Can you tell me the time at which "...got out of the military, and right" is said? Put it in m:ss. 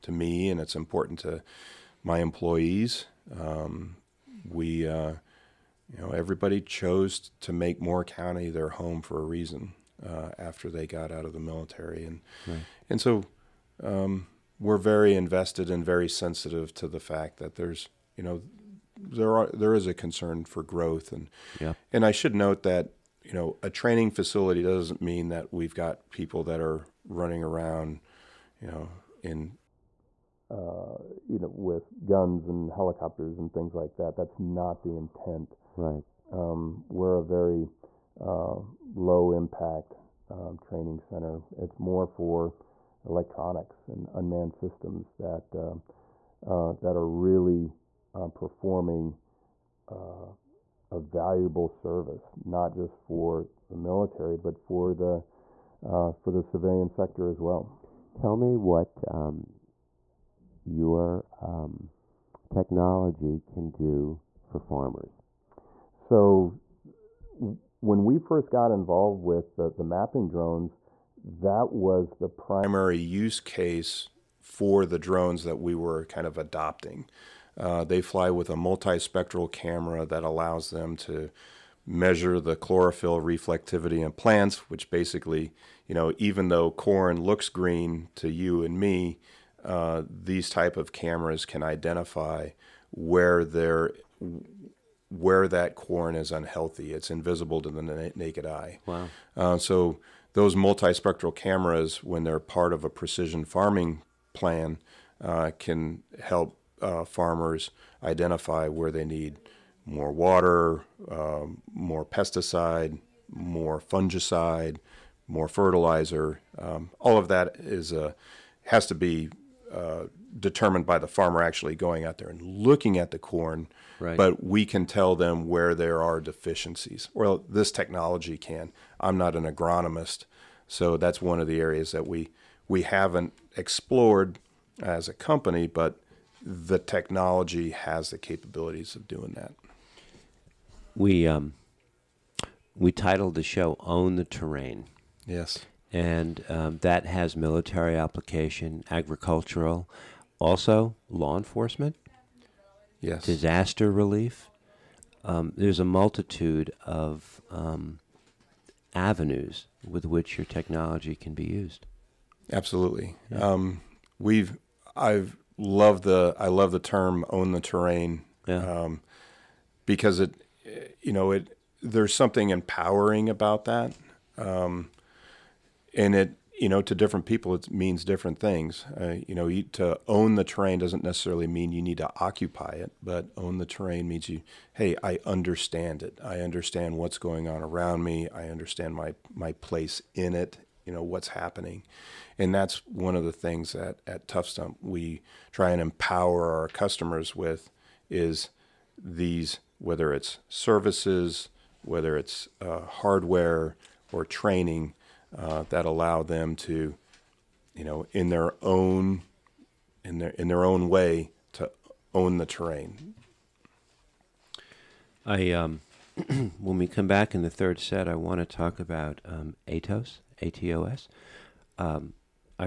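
0:10.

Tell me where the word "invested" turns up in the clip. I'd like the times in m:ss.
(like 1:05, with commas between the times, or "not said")
0:15.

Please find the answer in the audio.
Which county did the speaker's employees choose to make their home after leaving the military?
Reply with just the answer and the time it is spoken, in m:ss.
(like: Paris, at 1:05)
Moore County, at 0:07.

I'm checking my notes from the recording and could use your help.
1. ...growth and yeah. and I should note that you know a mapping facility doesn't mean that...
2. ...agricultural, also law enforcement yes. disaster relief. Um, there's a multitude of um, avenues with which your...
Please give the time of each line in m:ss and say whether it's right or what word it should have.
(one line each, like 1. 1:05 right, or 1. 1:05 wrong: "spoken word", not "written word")
1. 0:20 wrong: "training", not "mapping"
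2. 2:28 right.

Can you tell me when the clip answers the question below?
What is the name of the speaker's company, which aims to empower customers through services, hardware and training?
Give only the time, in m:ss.
3:14.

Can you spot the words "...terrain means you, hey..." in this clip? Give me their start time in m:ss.
3:03.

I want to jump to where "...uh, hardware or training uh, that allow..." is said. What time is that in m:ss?
3:22.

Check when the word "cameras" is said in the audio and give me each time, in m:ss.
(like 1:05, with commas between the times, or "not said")
1:19, 1:30, 1:41.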